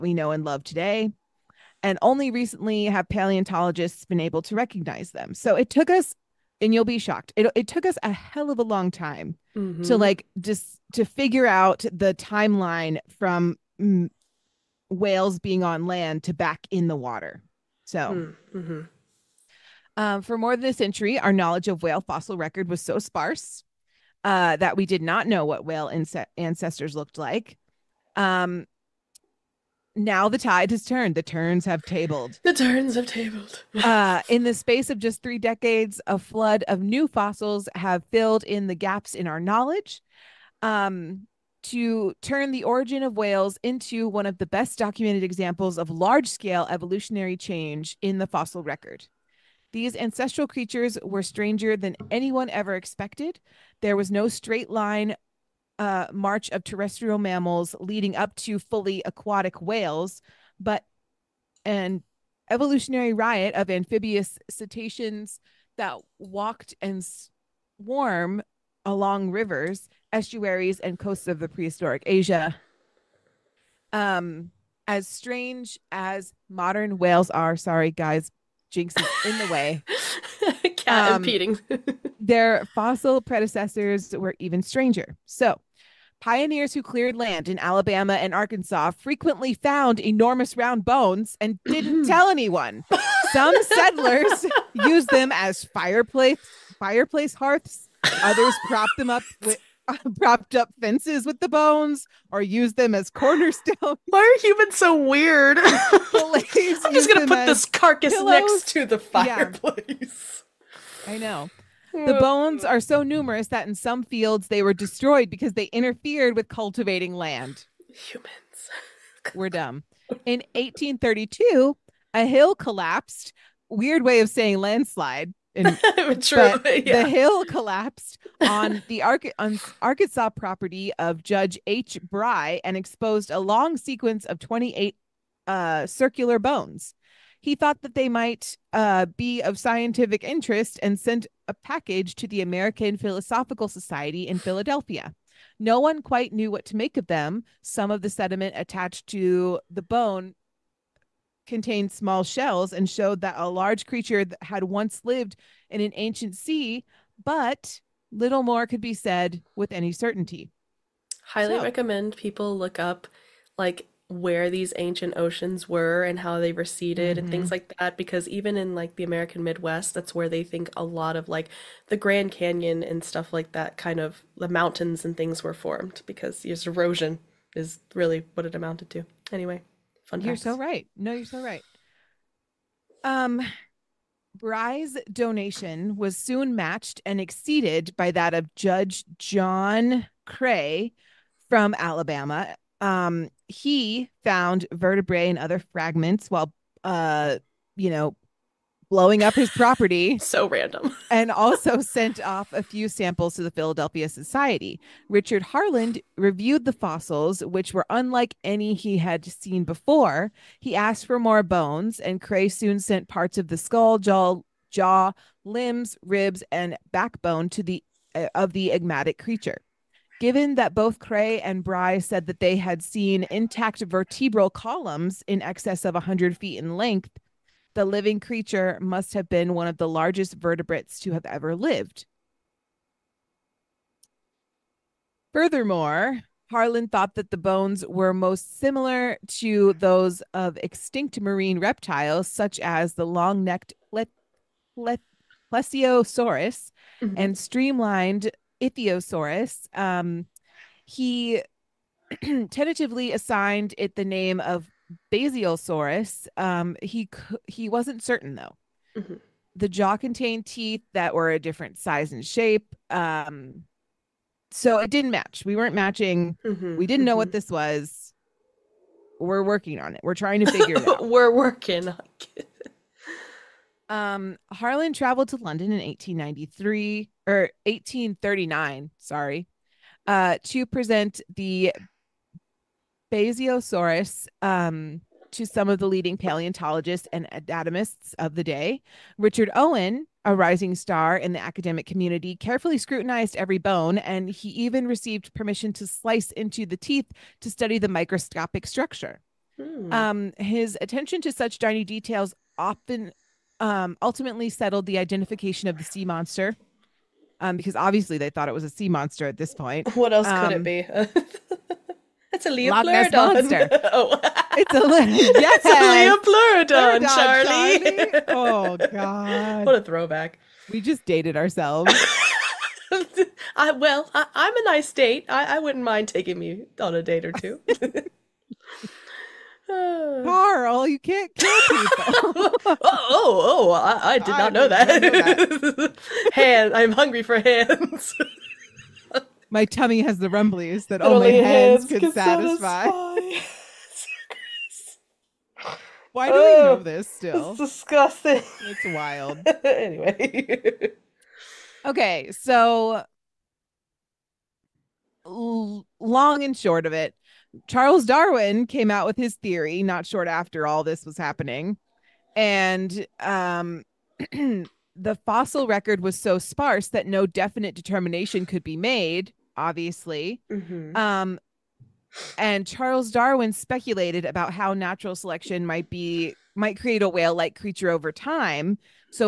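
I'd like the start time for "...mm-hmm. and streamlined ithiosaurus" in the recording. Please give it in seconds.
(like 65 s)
247 s.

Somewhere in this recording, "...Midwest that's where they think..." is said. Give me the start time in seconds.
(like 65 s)
169 s.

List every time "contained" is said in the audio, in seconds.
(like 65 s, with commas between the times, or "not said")
151 s, 259 s.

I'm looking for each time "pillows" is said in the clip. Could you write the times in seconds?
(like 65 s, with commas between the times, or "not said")
108 s.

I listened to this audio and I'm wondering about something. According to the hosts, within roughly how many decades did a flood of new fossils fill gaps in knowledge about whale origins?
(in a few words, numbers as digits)
3.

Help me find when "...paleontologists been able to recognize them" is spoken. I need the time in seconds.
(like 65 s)
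3 s.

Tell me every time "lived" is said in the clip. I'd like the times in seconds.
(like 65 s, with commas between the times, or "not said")
155 s, 231 s.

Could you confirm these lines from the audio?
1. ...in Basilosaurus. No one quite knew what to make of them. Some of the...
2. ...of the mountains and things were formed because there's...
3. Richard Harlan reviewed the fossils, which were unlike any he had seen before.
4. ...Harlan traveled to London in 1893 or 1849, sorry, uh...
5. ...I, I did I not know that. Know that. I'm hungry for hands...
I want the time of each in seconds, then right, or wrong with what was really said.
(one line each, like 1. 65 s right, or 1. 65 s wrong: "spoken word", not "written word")
1. 144 s wrong: "Philadelphia", not "Basilosaurus"
2. 174 s right
3. 205 s right
4. 274 s wrong: "1839", not "1849"
5. 333 s right.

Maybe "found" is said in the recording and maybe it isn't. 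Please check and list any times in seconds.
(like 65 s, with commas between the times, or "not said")
89 s, 194 s.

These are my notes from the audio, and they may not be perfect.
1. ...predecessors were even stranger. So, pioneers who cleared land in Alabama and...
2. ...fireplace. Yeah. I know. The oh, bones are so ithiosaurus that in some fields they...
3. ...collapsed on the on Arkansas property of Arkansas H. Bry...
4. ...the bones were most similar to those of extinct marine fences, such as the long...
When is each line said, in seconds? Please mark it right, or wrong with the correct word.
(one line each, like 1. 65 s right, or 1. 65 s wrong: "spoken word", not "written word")
1. 83 s right
2. 108 s wrong: "numerous", not "ithiosaurus"
3. 127 s wrong: "Judge", not "Arkansas"
4. 237 s wrong: "reptiles", not "fences".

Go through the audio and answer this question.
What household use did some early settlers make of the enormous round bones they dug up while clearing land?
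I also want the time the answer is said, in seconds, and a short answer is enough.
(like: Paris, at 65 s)
Fireplace hearths, at 96 s.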